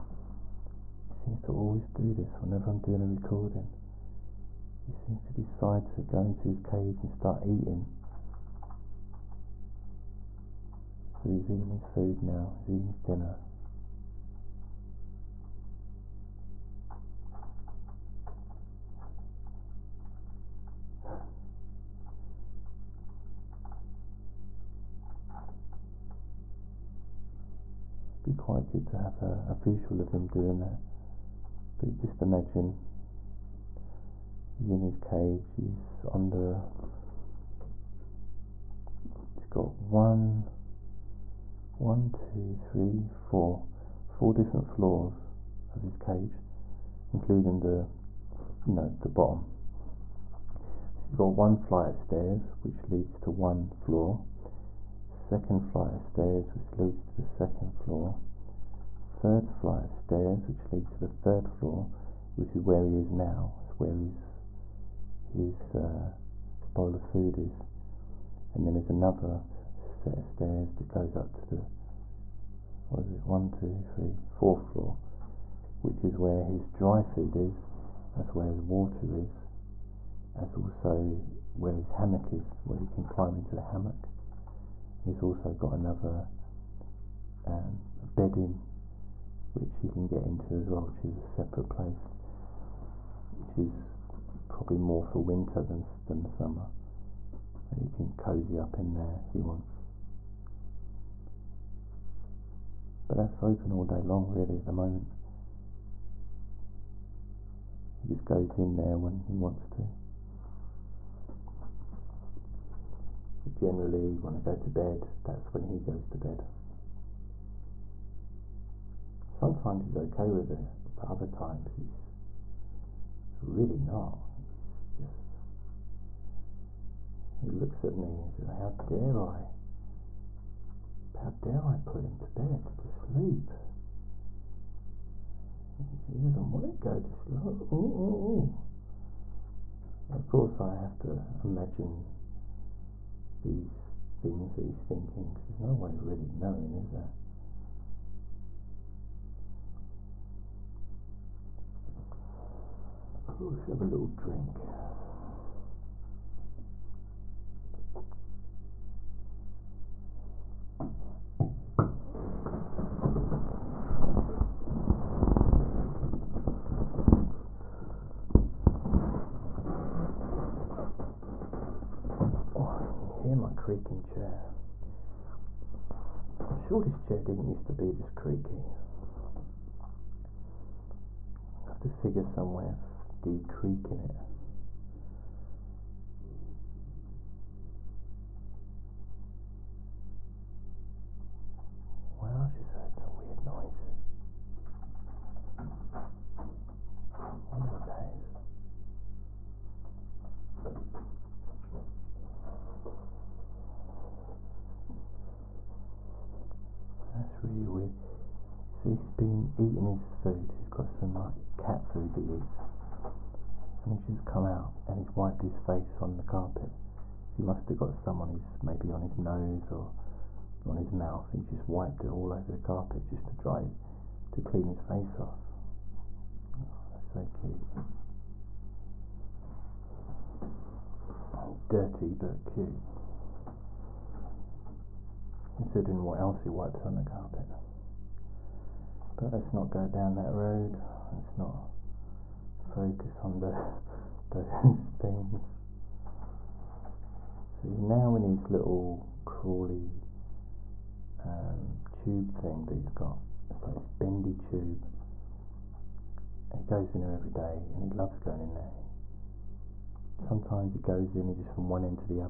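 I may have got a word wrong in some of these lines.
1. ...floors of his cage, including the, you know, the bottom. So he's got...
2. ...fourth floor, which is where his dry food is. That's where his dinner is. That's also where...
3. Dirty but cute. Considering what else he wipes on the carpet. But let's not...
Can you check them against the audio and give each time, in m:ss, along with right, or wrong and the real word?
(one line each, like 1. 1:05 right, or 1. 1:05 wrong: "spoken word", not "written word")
1. 0:44 right
2. 1:14 wrong: "water", not "dinner"
3. 3:51 right.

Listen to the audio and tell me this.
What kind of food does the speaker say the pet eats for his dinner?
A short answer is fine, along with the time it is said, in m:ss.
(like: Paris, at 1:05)
cat food, at 3:31.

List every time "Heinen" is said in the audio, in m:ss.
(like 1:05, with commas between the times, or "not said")
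not said.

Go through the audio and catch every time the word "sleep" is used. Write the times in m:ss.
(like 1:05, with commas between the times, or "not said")
2:12, 2:17.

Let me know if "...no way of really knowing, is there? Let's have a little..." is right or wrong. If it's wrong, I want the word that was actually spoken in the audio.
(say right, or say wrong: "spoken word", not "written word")
right.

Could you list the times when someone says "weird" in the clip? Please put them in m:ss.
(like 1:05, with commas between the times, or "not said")
3:13, 3:27.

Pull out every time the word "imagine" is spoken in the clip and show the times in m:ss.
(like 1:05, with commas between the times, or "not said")
0:32, 2:21.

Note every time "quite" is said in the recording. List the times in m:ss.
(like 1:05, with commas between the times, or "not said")
0:28.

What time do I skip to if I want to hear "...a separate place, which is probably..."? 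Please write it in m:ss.
1:31.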